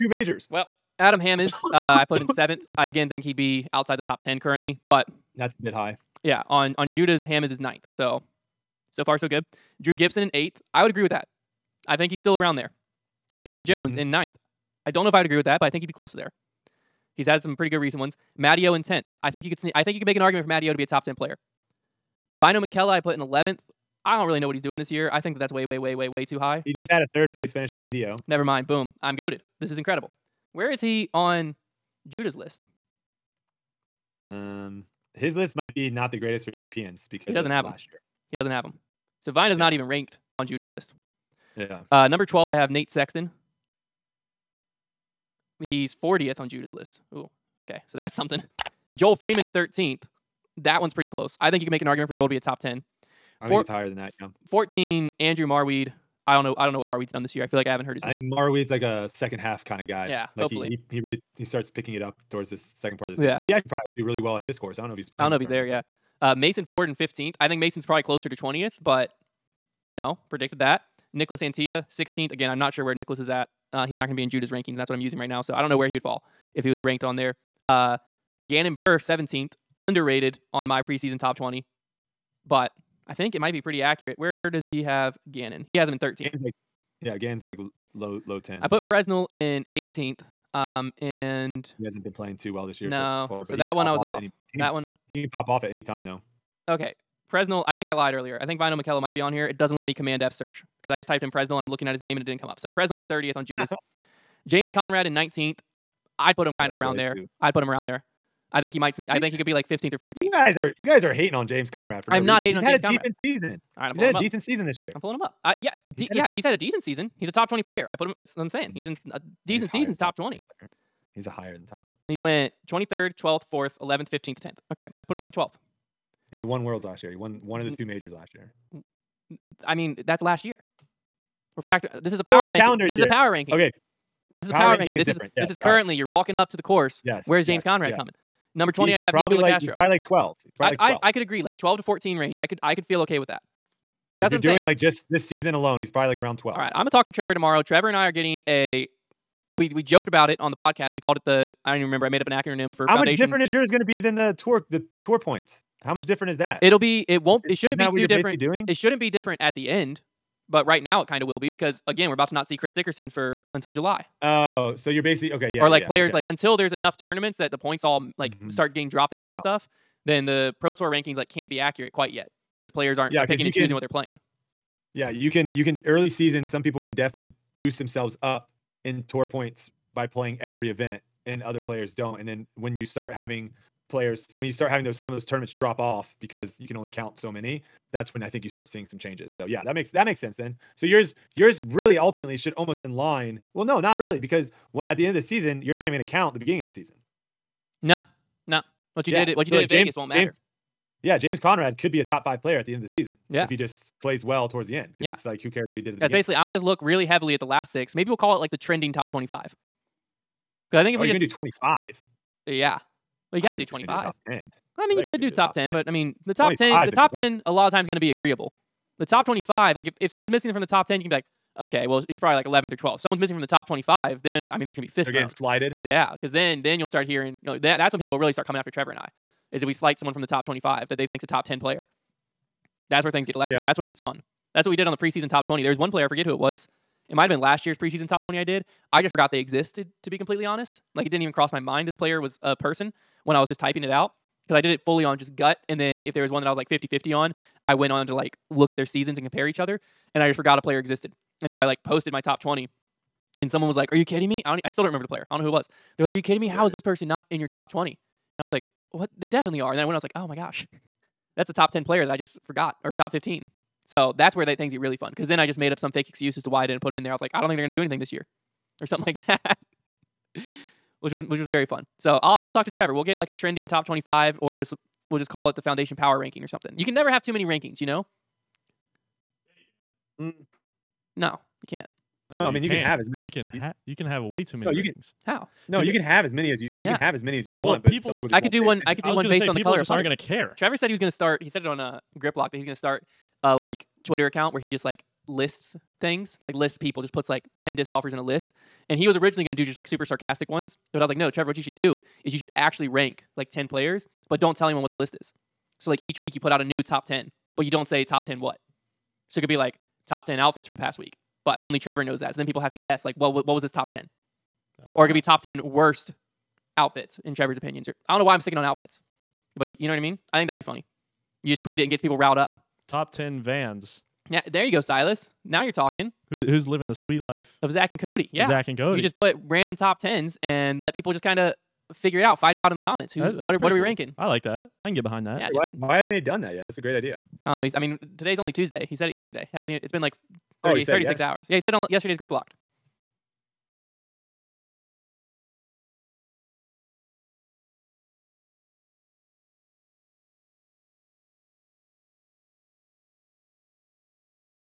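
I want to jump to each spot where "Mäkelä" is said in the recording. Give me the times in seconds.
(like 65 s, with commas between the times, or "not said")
22 s, 98 s.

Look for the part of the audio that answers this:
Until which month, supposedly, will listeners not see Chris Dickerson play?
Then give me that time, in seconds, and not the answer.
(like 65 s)
163 s.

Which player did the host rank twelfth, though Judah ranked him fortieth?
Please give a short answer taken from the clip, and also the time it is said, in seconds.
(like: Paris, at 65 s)
Nate Sexton, at 42 s.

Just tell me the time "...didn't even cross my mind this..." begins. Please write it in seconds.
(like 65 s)
241 s.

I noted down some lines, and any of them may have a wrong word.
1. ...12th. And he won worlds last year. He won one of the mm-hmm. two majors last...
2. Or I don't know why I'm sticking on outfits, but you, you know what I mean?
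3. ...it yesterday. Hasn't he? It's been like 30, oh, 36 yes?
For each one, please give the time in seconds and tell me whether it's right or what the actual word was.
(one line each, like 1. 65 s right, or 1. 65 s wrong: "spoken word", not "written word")
1. 125 s right
2. 317 s right
3. 339 s right.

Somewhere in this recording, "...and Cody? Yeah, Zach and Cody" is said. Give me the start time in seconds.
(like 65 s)
327 s.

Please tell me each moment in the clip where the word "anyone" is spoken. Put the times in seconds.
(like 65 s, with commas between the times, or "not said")
304 s.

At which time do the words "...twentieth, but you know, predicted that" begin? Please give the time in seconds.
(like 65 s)
68 s.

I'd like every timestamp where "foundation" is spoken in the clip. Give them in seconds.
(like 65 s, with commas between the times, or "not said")
152 s, 275 s.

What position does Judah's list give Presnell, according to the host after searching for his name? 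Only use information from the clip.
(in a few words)
30th.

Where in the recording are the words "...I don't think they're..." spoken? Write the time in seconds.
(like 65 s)
267 s.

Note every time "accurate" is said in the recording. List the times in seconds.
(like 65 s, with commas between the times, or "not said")
83 s, 171 s.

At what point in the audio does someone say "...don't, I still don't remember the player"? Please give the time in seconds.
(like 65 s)
254 s.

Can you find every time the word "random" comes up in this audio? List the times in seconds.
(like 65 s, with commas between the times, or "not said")
329 s.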